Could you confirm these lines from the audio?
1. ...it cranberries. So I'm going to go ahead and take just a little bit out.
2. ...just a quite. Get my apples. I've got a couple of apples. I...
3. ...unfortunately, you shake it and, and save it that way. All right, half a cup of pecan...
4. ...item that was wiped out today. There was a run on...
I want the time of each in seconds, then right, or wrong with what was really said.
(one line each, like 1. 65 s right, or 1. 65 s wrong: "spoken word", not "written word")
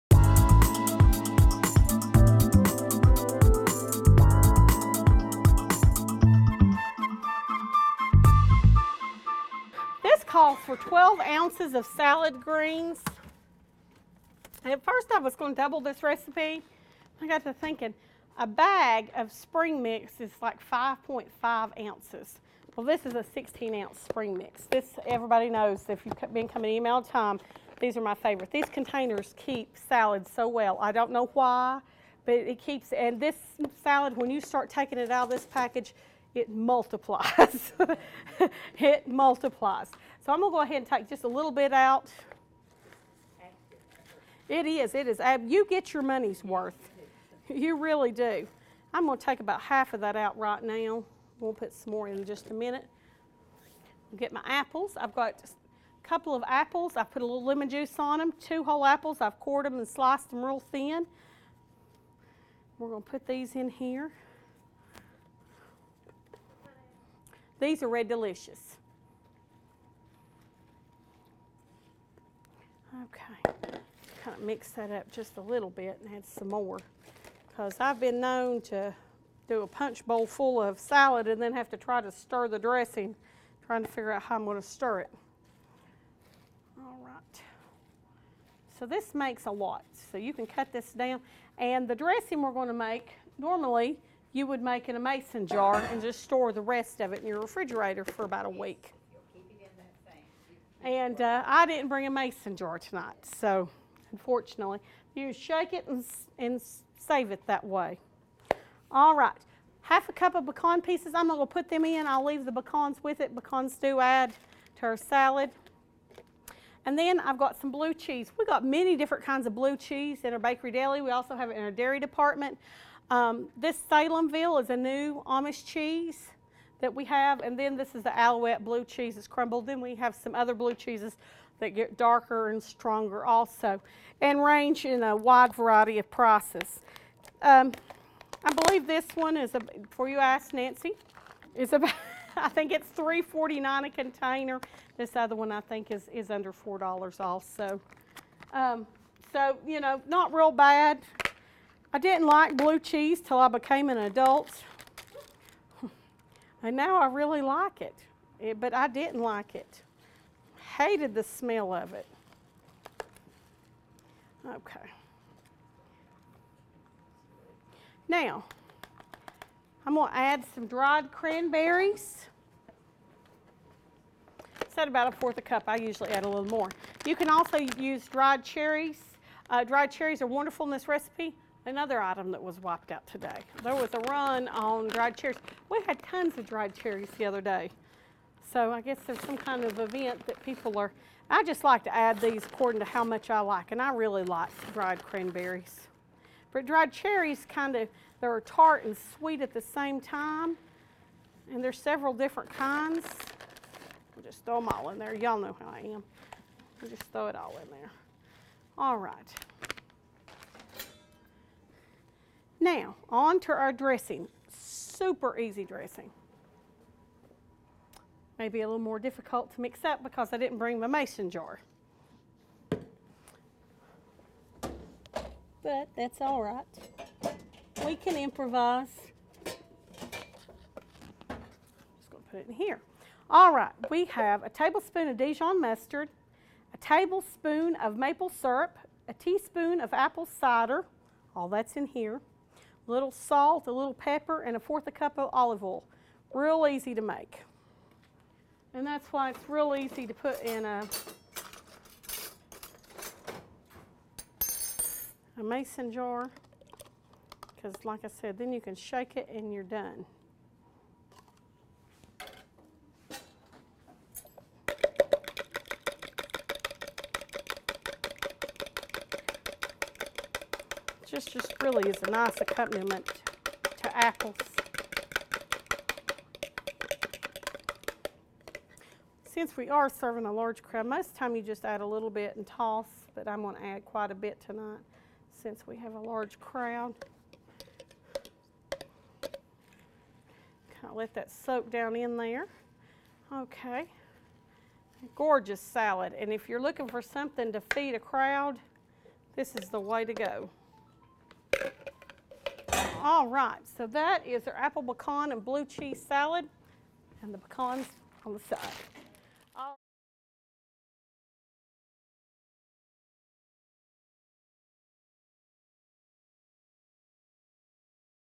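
1. 38 s wrong: "multiplies", not "cranberries"
2. 52 s wrong: "minute", not "quite"
3. 104 s right
4. 182 s right.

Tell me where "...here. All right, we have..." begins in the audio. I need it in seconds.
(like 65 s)
232 s.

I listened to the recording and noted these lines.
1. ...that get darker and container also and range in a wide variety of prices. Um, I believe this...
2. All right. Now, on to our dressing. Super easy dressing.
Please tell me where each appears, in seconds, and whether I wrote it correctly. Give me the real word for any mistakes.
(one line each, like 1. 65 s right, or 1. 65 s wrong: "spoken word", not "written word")
1. 131 s wrong: "stronger", not "container"
2. 208 s right.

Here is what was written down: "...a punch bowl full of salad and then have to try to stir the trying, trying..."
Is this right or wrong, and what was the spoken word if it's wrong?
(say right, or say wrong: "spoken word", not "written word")
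wrong: "dressing", not "trying".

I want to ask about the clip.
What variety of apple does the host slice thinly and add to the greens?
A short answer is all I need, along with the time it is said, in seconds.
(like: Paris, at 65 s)
Red Delicious, at 67 s.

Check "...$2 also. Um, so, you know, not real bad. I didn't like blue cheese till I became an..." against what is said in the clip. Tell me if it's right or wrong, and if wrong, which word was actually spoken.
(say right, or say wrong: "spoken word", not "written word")
wrong: "4", not "2".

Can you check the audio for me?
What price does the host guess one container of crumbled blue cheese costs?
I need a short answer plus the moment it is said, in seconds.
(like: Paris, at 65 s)
$3.49, at 142 s.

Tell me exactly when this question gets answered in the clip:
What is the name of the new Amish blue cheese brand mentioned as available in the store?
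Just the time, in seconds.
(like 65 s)
123 s.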